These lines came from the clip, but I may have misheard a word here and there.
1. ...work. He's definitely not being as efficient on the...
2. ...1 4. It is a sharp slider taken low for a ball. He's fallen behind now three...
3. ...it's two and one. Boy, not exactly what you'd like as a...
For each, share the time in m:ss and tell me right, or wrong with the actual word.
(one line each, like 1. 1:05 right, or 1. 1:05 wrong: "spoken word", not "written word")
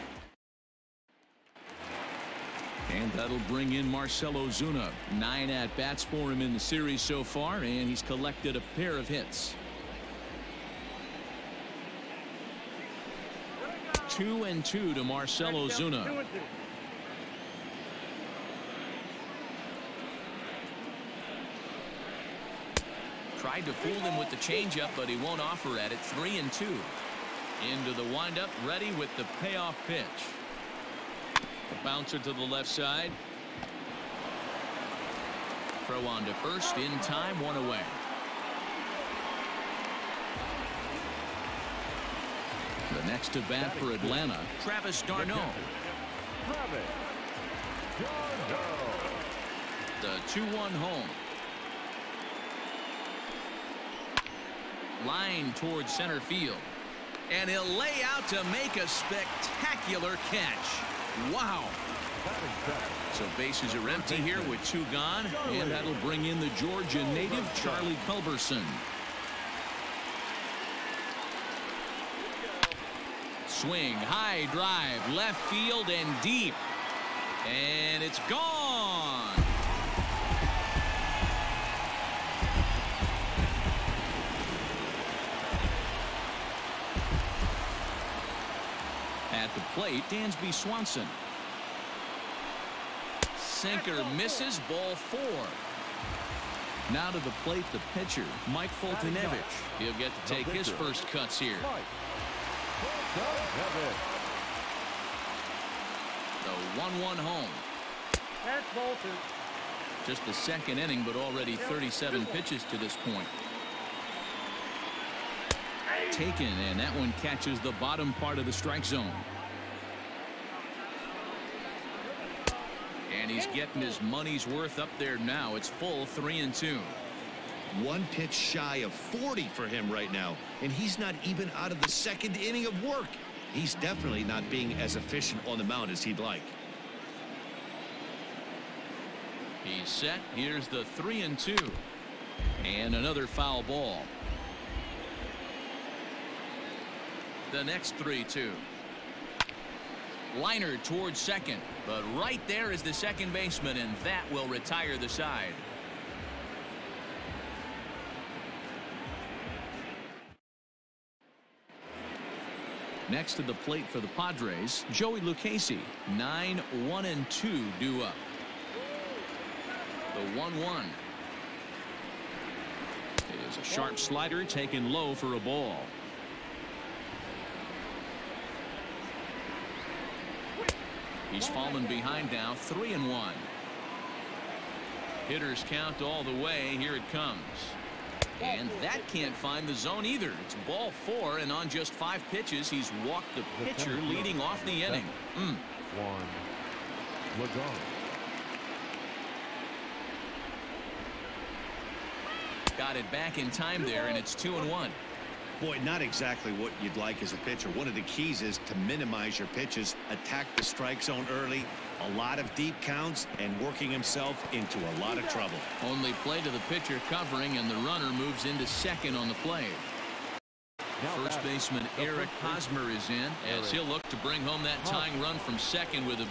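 1. 2:12 right
2. 2:50 wrong: "1", not "4"
3. 3:24 right.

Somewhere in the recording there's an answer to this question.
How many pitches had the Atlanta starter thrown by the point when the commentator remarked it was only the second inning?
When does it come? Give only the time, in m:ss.
1:51.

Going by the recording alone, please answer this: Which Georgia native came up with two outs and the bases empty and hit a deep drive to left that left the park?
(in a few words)
Charlie Culberson.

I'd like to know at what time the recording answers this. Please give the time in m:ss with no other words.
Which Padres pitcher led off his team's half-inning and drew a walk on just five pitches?
2:44.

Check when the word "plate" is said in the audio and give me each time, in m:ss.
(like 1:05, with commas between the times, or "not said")
1:37, 2:43.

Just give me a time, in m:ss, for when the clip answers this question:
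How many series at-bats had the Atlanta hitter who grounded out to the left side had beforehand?
0:05.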